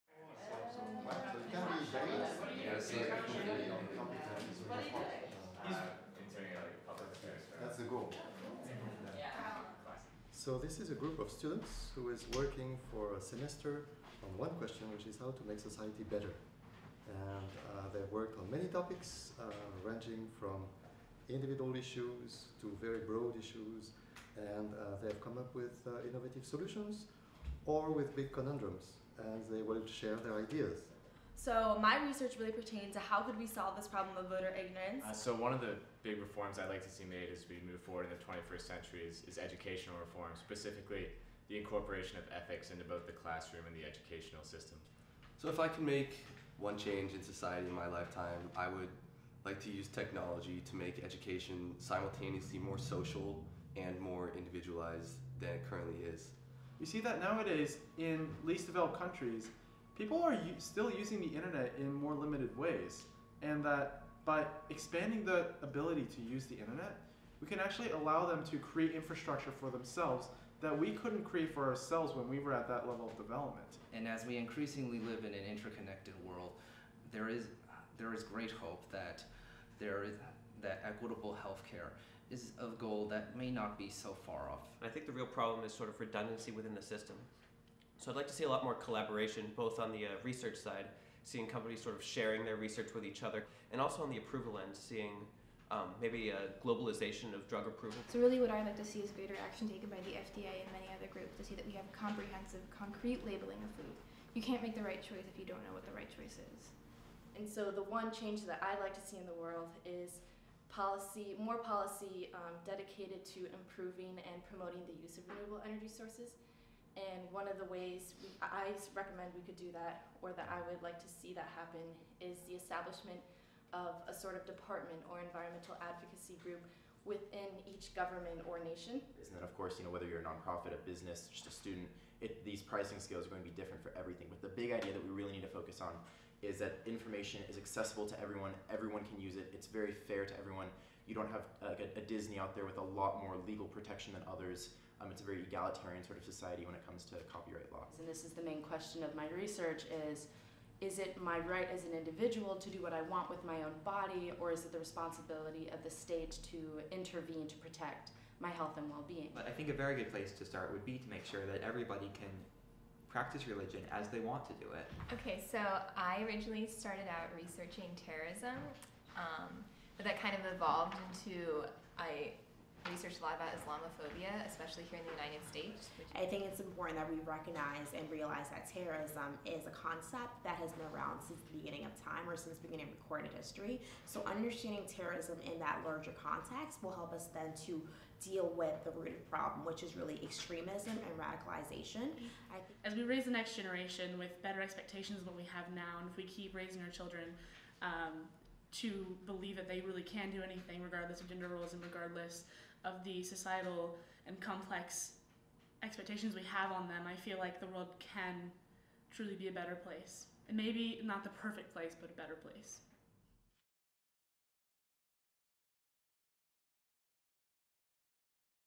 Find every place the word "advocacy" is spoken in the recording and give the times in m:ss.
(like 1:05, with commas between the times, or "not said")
2:05.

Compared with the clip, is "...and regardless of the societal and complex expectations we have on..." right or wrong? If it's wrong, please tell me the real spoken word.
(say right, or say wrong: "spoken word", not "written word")
right.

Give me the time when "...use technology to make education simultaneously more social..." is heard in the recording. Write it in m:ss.
0:49.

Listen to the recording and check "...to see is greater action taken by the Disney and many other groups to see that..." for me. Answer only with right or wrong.
wrong.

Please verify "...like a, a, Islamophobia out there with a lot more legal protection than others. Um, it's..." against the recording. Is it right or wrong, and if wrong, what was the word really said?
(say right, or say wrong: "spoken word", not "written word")
wrong: "Disney", not "Islamophobia".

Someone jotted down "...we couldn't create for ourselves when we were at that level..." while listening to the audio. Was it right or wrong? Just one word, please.
right.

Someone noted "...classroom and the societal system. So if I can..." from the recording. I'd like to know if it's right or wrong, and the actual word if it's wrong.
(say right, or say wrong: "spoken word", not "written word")
wrong: "educational", not "societal".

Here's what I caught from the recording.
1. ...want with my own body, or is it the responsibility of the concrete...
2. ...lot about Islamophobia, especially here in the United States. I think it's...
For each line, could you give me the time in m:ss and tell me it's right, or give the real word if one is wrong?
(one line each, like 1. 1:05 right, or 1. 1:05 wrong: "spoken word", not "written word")
1. 2:33 wrong: "state", not "concrete"
2. 2:53 right.